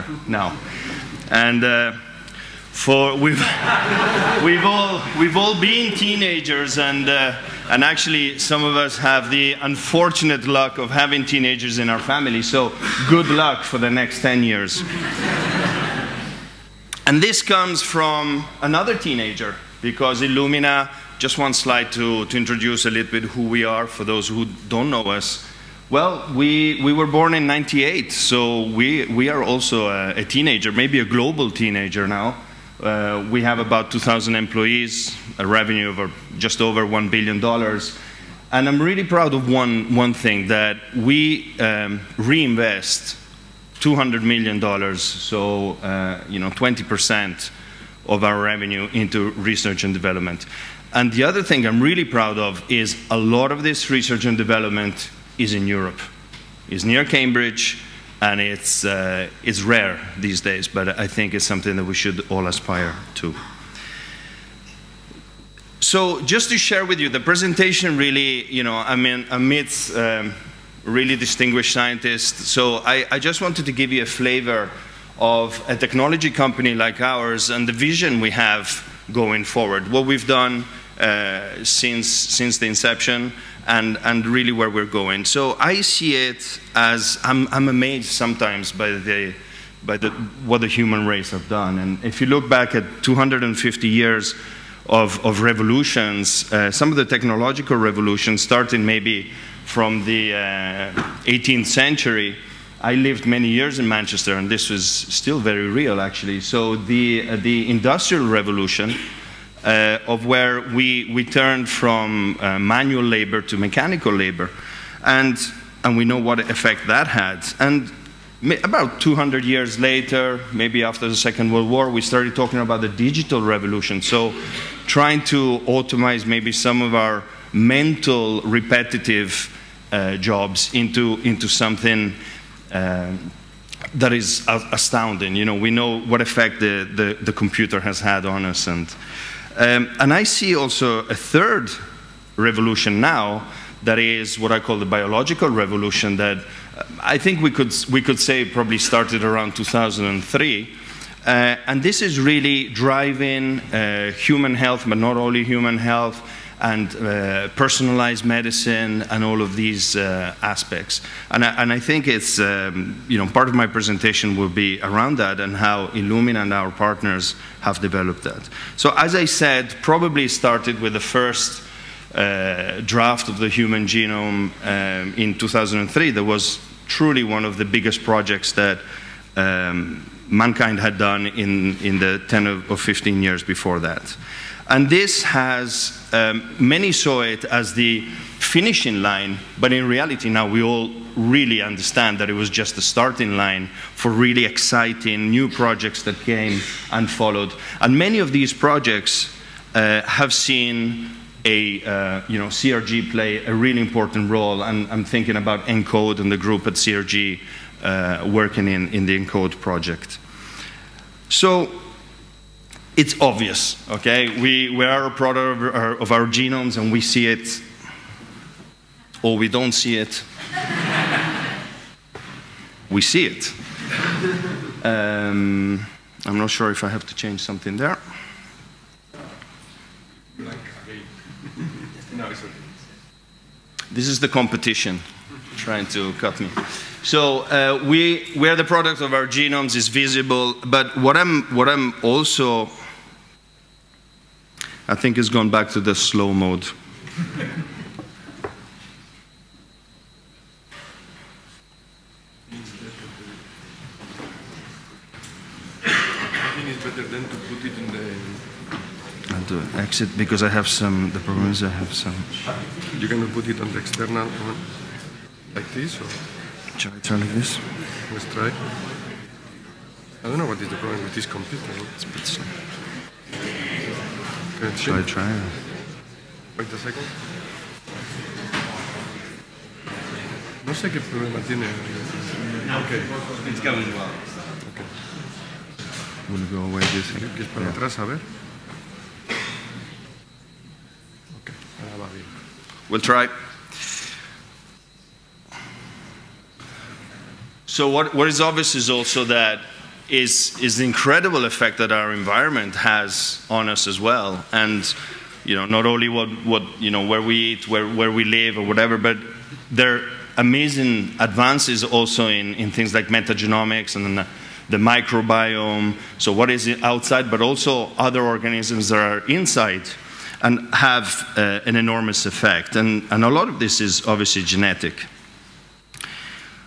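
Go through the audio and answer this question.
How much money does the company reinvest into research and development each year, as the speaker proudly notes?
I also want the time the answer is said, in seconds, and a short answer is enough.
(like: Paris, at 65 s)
$200 million, at 43 s.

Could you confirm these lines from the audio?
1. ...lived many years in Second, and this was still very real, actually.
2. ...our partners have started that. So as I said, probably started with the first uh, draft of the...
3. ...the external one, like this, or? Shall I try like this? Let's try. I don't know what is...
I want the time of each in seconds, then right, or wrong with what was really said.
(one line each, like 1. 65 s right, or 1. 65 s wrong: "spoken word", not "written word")
1. 102 s wrong: "Manchester", not "Second"
2. 166 s wrong: "developed", not "started"
3. 263 s right.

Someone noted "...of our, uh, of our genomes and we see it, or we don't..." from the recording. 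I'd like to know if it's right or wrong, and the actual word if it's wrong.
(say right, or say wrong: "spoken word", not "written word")
right.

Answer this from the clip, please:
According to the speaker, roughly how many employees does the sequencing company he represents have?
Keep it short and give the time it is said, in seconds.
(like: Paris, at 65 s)
2,000, at 33 s.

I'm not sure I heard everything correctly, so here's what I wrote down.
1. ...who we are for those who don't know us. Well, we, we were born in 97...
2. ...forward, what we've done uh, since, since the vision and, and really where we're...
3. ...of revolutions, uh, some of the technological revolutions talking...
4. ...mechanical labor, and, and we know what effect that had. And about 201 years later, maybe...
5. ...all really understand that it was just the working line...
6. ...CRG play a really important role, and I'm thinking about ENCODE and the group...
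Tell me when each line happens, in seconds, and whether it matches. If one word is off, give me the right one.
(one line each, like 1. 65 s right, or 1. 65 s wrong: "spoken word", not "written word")
1. 23 s wrong: "98", not "97"
2. 79 s wrong: "inception", not "vision"
3. 95 s wrong: "starting", not "talking"
4. 113 s wrong: "200", not "201"
5. 190 s wrong: "starting", not "working"
6. 202 s right.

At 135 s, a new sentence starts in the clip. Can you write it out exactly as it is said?
You know, we know what effect the, the, the computer has had on us.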